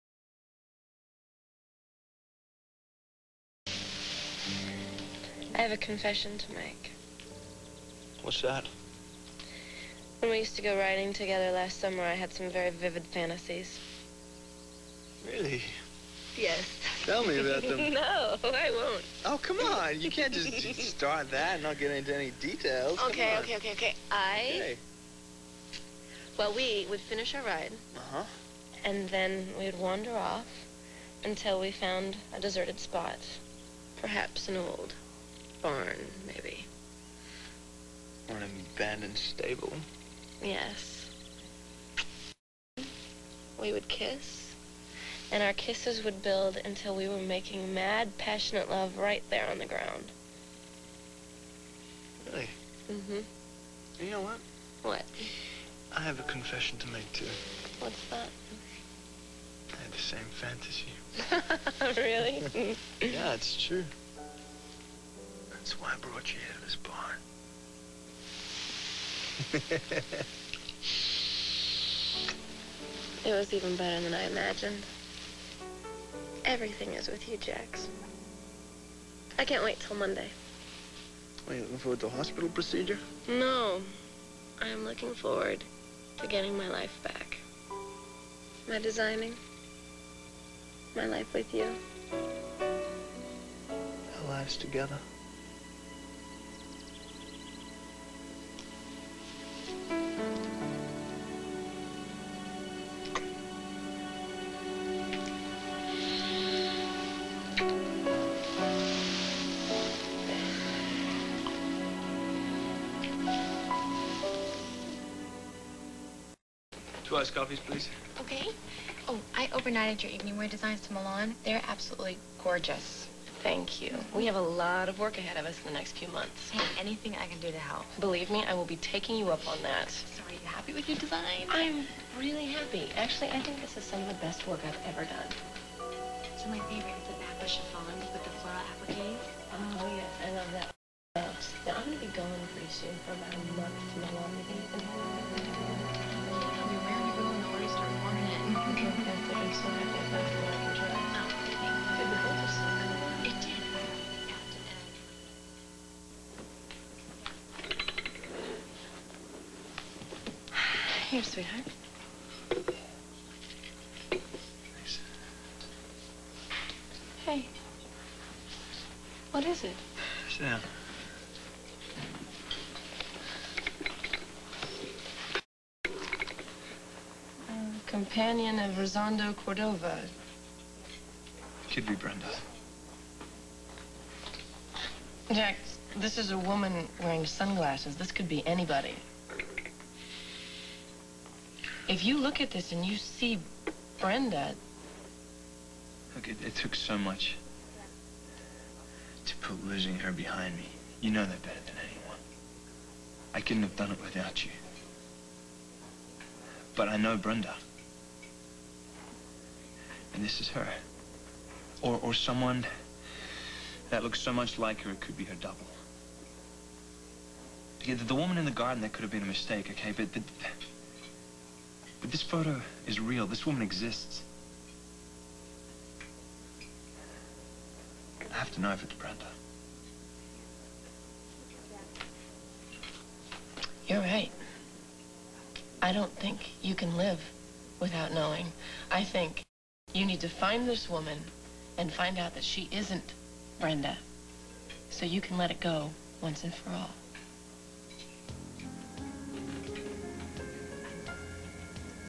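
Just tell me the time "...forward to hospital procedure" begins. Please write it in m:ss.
1:21.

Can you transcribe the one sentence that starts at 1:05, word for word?
That's why I brought you here to this barn.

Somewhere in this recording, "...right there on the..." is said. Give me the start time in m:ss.
0:48.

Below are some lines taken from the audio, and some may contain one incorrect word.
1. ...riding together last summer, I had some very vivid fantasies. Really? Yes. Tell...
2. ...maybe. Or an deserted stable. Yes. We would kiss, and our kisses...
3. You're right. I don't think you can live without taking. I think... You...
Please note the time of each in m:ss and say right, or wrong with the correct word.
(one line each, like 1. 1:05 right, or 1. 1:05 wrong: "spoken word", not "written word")
1. 0:10 right
2. 0:36 wrong: "abandoned", not "deserted"
3. 3:53 wrong: "knowing", not "taking".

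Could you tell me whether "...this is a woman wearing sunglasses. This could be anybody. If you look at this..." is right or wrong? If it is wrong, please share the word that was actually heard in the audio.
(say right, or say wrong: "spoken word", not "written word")
right.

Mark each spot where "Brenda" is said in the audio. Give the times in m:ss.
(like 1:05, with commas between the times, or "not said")
3:01, 3:13, 3:27, 3:48, 4:03.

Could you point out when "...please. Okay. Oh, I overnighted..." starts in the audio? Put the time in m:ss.
1:57.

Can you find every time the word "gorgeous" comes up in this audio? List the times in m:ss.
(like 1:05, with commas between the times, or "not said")
2:02.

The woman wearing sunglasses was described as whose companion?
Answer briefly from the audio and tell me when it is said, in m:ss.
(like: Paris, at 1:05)
Rosando Cordova, at 2:58.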